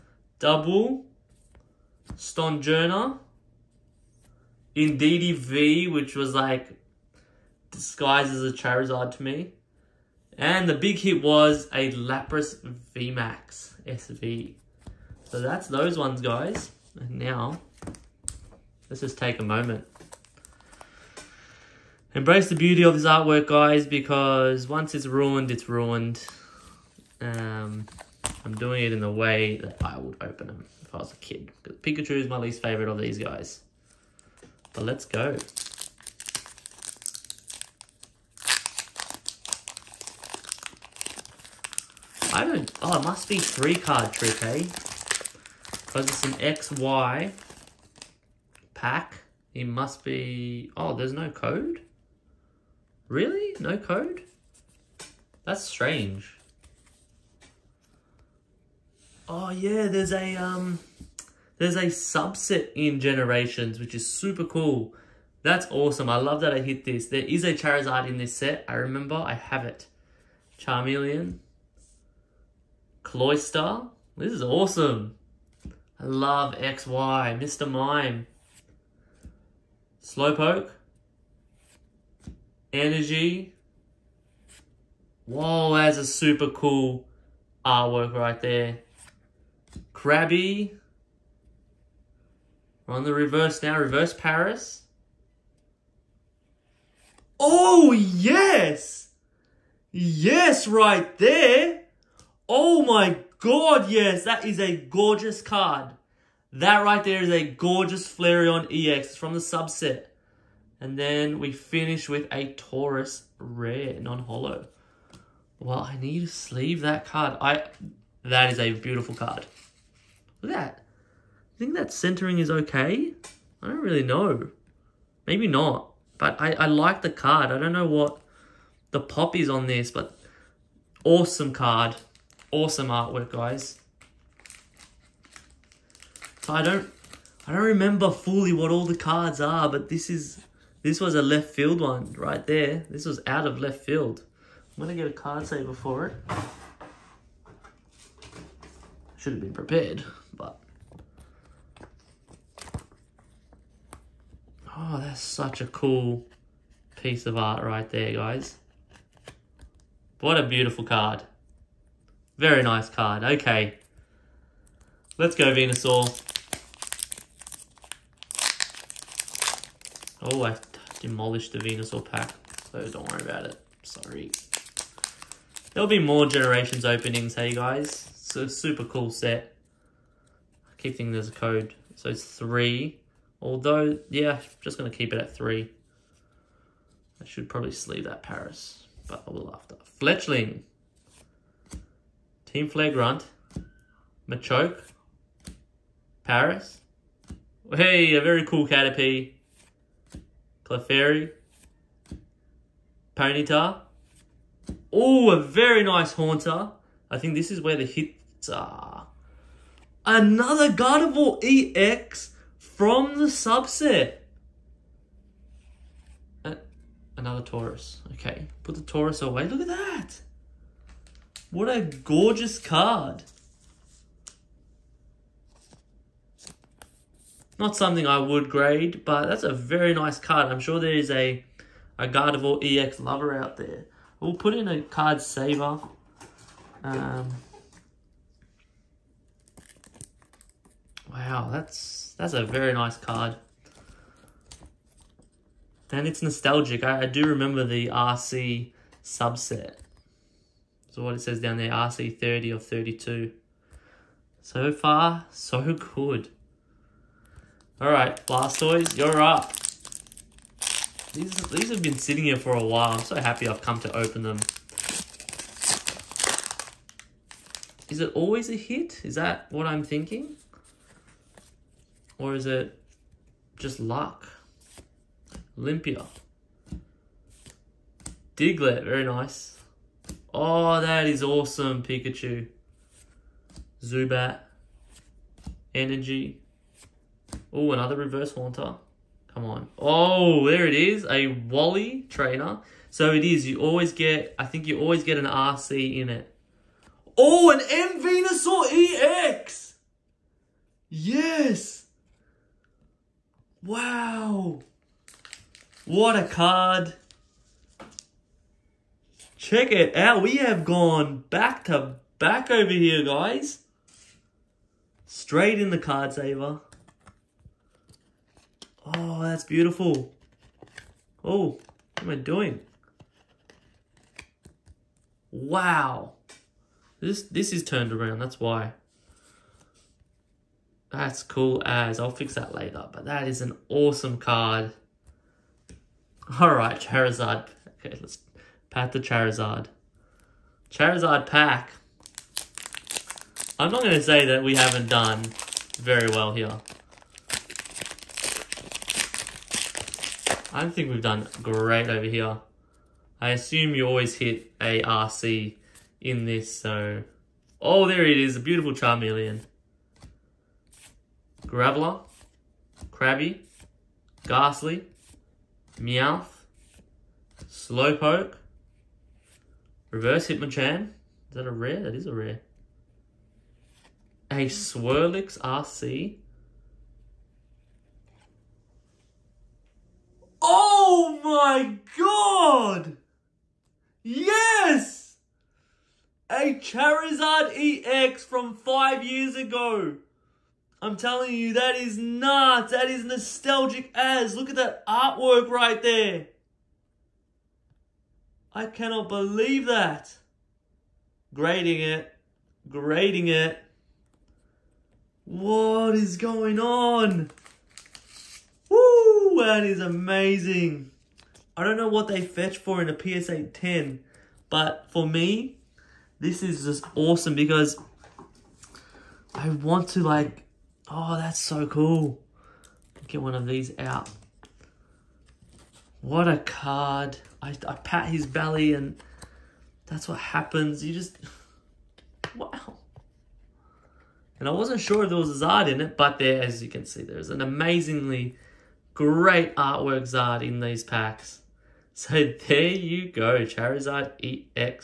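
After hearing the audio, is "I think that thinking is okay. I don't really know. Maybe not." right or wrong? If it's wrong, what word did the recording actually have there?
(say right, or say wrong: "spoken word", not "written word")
wrong: "centering", not "thinking".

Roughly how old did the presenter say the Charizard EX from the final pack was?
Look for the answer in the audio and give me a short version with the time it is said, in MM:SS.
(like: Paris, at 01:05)
5 years, at 06:28.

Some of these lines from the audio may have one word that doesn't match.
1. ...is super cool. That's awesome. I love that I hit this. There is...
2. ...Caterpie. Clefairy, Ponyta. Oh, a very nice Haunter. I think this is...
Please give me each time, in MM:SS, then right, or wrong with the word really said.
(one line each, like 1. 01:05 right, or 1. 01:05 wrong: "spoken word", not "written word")
1. 01:03 right
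2. 03:18 right.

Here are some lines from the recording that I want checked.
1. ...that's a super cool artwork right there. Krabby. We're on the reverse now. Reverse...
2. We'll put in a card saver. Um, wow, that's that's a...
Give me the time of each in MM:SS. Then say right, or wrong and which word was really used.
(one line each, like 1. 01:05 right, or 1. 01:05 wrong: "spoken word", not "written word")
1. 01:25 right
2. 03:54 right.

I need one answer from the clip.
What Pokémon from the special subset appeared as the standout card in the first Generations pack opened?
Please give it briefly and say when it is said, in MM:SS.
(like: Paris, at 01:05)
Flareon EX, at 01:48.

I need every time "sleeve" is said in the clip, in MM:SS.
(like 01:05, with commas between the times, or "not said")
01:56, 03:07.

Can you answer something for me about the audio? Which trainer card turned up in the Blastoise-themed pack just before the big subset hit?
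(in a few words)
Wally.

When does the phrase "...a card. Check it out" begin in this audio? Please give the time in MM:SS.
05:06.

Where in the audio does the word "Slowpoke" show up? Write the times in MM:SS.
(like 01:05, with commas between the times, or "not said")
01:20, 06:07.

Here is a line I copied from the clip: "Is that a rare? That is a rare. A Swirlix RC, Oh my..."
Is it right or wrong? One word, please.
right.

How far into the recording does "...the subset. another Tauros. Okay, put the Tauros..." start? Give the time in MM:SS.
03:33.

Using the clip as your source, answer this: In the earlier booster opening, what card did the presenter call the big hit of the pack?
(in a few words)
Lapras VMAX SV.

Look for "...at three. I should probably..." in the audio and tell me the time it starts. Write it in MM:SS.
03:05.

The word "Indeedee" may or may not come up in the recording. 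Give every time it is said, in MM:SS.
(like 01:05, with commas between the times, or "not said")
00:04.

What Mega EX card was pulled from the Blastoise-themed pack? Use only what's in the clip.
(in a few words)
M Venusaur EX.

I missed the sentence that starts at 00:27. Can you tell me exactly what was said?
Um, I'm doing it in the way that I would open them if I was a kid.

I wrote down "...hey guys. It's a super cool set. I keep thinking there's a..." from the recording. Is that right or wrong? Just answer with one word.
right.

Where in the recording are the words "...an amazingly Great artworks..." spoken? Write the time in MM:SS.
07:17.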